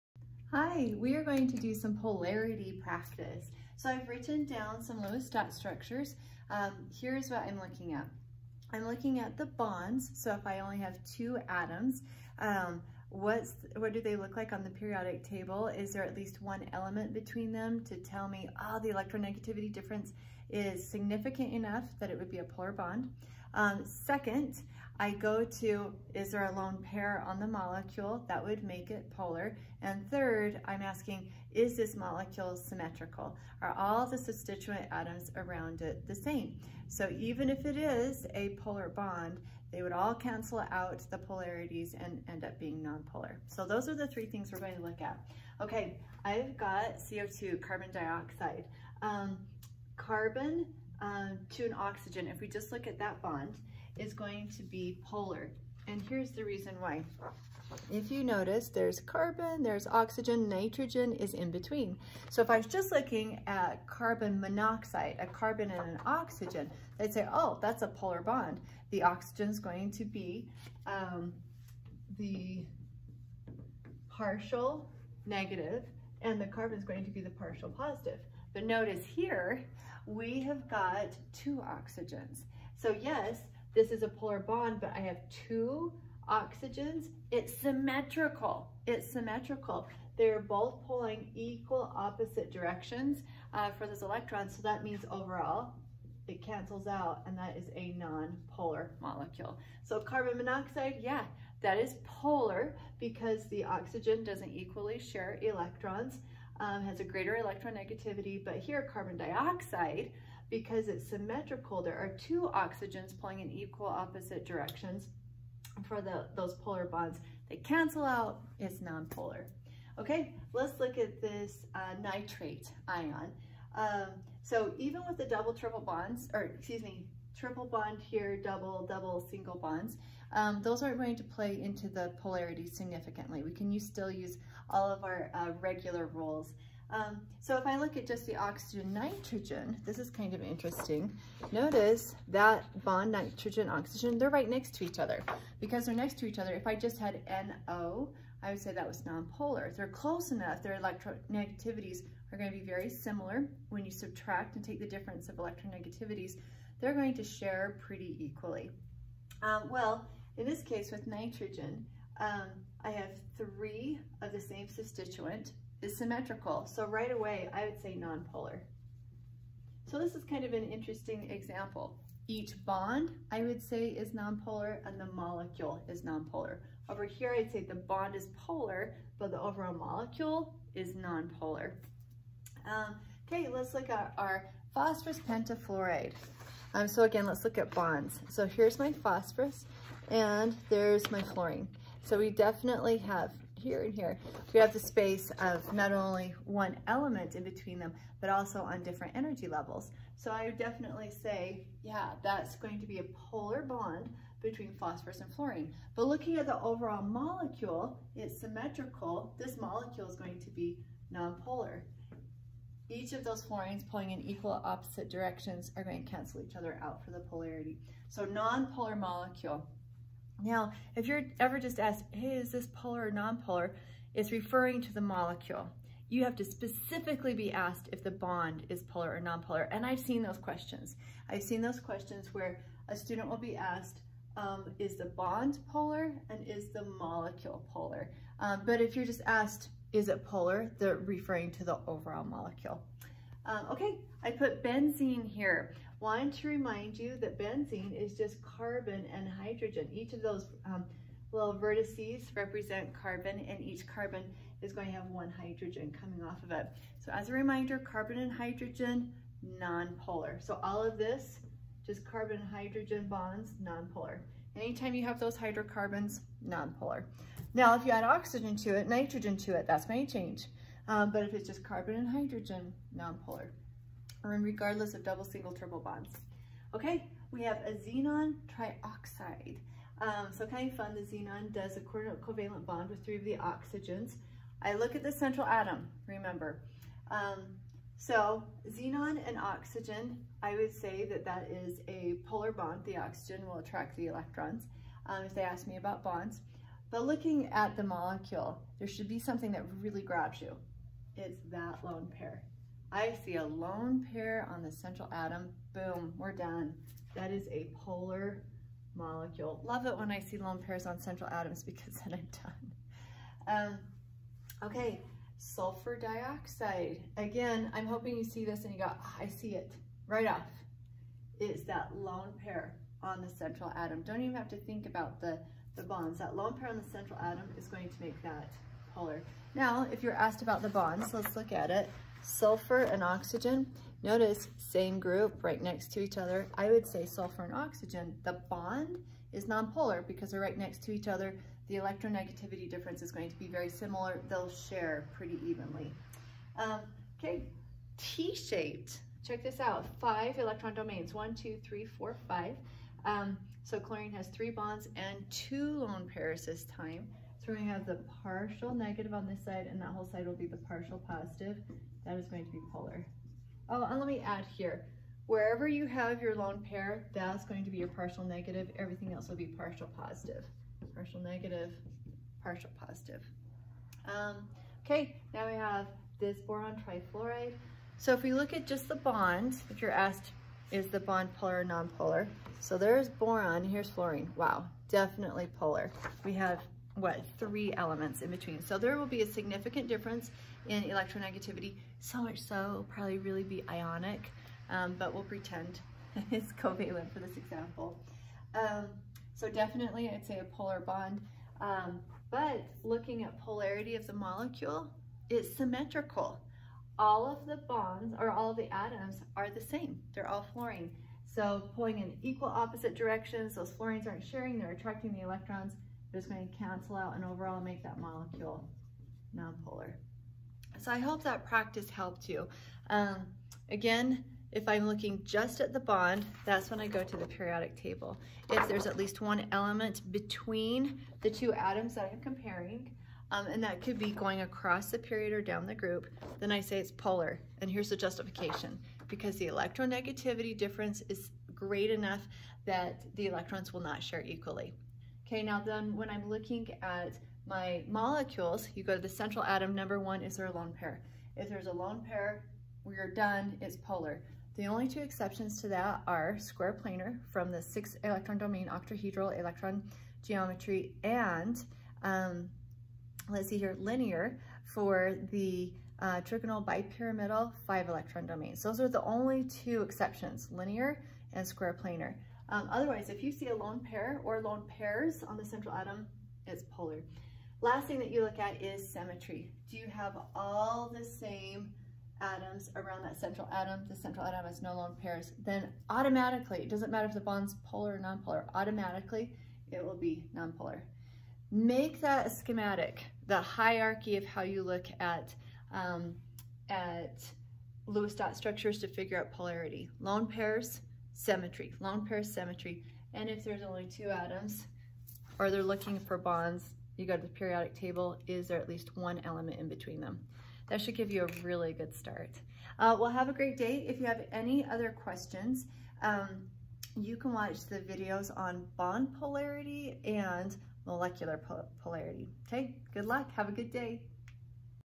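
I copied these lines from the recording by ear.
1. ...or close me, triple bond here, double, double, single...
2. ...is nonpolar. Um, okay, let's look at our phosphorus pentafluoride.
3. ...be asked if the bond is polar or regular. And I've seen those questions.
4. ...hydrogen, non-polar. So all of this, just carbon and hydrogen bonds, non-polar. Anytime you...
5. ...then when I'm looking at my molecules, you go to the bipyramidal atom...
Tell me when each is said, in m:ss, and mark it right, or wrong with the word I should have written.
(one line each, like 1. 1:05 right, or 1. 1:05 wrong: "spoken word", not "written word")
1. 2:06 wrong: "excuse", not "close"
2. 3:00 right
3. 3:47 wrong: "nonpolar", not "regular"
4. 4:18 right
5. 7:25 wrong: "central", not "bipyramidal".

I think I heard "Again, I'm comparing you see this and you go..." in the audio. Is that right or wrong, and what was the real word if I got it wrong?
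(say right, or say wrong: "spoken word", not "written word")
wrong: "hoping", not "comparing".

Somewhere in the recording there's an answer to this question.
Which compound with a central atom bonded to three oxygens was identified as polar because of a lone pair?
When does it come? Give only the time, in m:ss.
4:37.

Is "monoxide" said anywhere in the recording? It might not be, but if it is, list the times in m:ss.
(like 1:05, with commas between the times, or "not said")
1:04, 1:40.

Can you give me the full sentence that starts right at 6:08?
Everything else will be partial positive.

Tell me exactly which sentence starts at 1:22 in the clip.
So yes, this is a polar bond, but I have two oxygens.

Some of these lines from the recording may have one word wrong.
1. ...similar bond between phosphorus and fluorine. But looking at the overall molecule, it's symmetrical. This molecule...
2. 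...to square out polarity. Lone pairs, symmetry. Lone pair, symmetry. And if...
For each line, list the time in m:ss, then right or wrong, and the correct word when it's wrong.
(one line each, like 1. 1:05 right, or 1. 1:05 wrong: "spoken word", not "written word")
1. 3:23 wrong: "polar", not "similar"
2. 8:18 wrong: "figure", not "square".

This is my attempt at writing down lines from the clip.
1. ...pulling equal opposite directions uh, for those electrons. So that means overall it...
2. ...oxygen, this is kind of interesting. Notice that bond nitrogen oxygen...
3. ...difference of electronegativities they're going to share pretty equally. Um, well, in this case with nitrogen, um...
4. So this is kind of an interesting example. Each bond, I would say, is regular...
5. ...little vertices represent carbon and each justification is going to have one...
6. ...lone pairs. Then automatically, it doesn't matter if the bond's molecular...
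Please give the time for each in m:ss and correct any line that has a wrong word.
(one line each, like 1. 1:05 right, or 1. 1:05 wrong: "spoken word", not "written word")
1. 1:30 right
2. 2:18 wrong: "nitrogen", not "oxygen"
3. 2:34 right
4. 2:49 wrong: "nonpolar", not "regular"
5. 4:11 wrong: "carbon", not "justification"
6. 8:04 wrong: "polar", not "molecular".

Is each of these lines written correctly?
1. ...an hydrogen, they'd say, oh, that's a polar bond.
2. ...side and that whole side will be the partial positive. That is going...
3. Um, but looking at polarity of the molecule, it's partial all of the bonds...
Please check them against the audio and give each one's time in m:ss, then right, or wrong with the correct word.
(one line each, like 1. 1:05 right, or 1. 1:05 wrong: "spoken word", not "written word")
1. 1:05 wrong: "oxygen", not "hydrogen"
2. 5:59 right
3. 6:41 wrong: "symmetrical", not "partial".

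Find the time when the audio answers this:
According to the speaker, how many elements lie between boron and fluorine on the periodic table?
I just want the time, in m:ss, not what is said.
6:27.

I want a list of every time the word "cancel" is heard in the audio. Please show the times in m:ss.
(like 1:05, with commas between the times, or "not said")
0:40, 1:36, 1:57, 3:36, 6:56.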